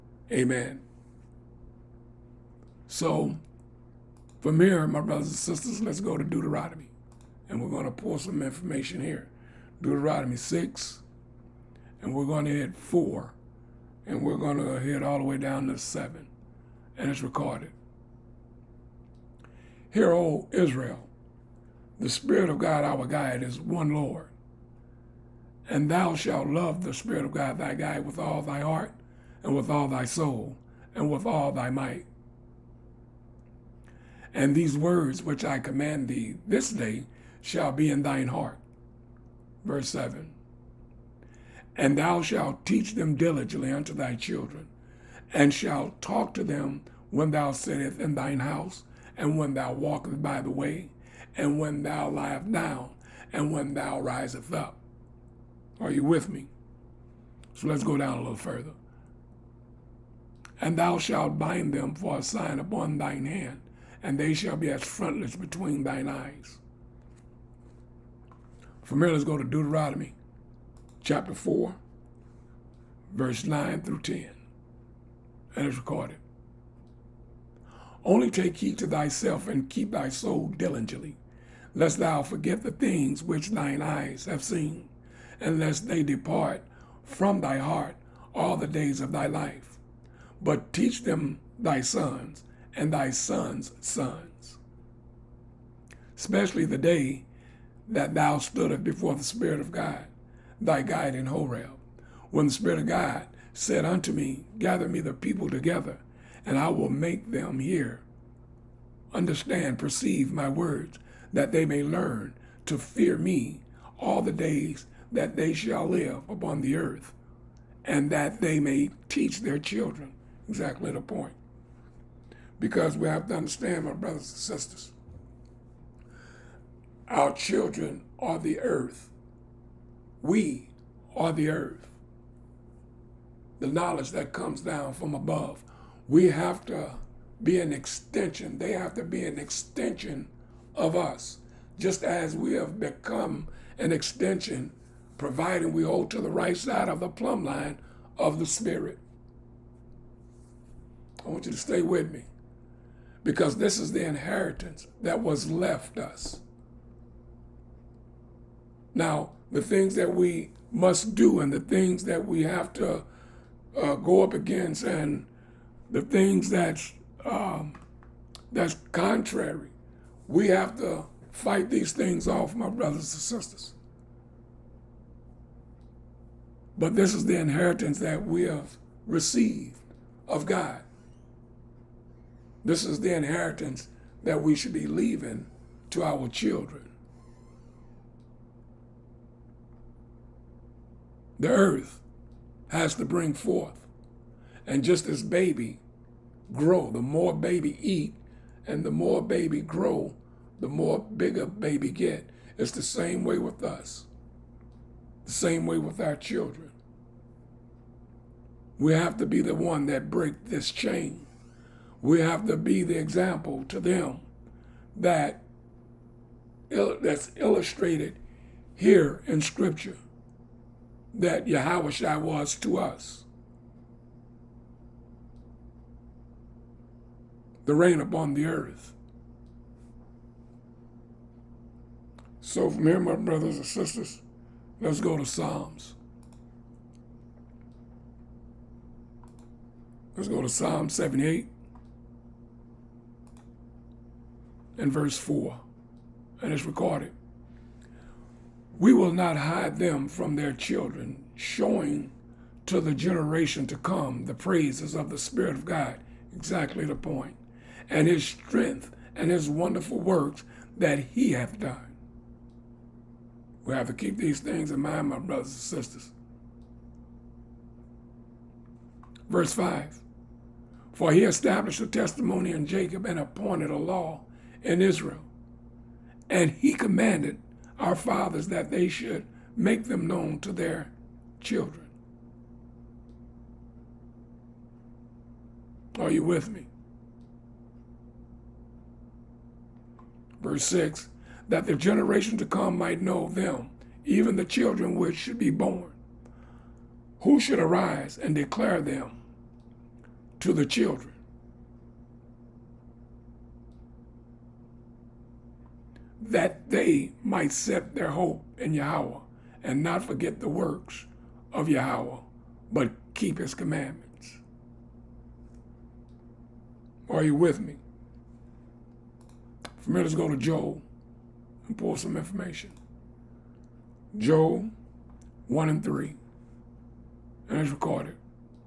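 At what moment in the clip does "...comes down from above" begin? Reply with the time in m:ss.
2:14.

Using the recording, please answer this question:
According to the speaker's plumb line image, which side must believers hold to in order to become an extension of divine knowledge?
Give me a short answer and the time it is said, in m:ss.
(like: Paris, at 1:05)
The right side, at 2:26.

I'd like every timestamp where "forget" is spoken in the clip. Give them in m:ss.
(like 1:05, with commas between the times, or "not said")
1:22, 5:10.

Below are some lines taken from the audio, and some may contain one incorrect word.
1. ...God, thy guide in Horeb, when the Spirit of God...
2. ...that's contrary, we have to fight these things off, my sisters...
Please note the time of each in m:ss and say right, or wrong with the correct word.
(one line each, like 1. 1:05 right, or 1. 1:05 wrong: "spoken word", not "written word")
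1. 1:39 right
2. 2:48 wrong: "brothers", not "sisters".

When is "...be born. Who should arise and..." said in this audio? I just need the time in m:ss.
4:55.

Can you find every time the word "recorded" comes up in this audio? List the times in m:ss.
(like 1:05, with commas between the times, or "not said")
0:17, 1:15, 4:06, 5:27.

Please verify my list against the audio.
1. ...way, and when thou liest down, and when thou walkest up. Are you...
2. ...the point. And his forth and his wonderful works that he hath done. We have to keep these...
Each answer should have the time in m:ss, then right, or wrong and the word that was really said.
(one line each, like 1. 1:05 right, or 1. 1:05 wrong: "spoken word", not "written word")
1. 0:50 wrong: "risest", not "walkest"
2. 4:16 wrong: "strength", not "forth".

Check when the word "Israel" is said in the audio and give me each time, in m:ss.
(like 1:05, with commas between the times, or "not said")
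0:20, 4:34.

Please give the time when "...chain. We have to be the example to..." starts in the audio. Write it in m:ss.
3:30.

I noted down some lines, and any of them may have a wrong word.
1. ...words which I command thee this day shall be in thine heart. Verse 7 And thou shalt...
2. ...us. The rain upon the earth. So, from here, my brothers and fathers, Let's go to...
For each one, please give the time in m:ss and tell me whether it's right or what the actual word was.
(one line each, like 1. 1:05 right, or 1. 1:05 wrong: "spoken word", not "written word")
1. 0:34 right
2. 3:42 wrong: "sisters", not "fathers".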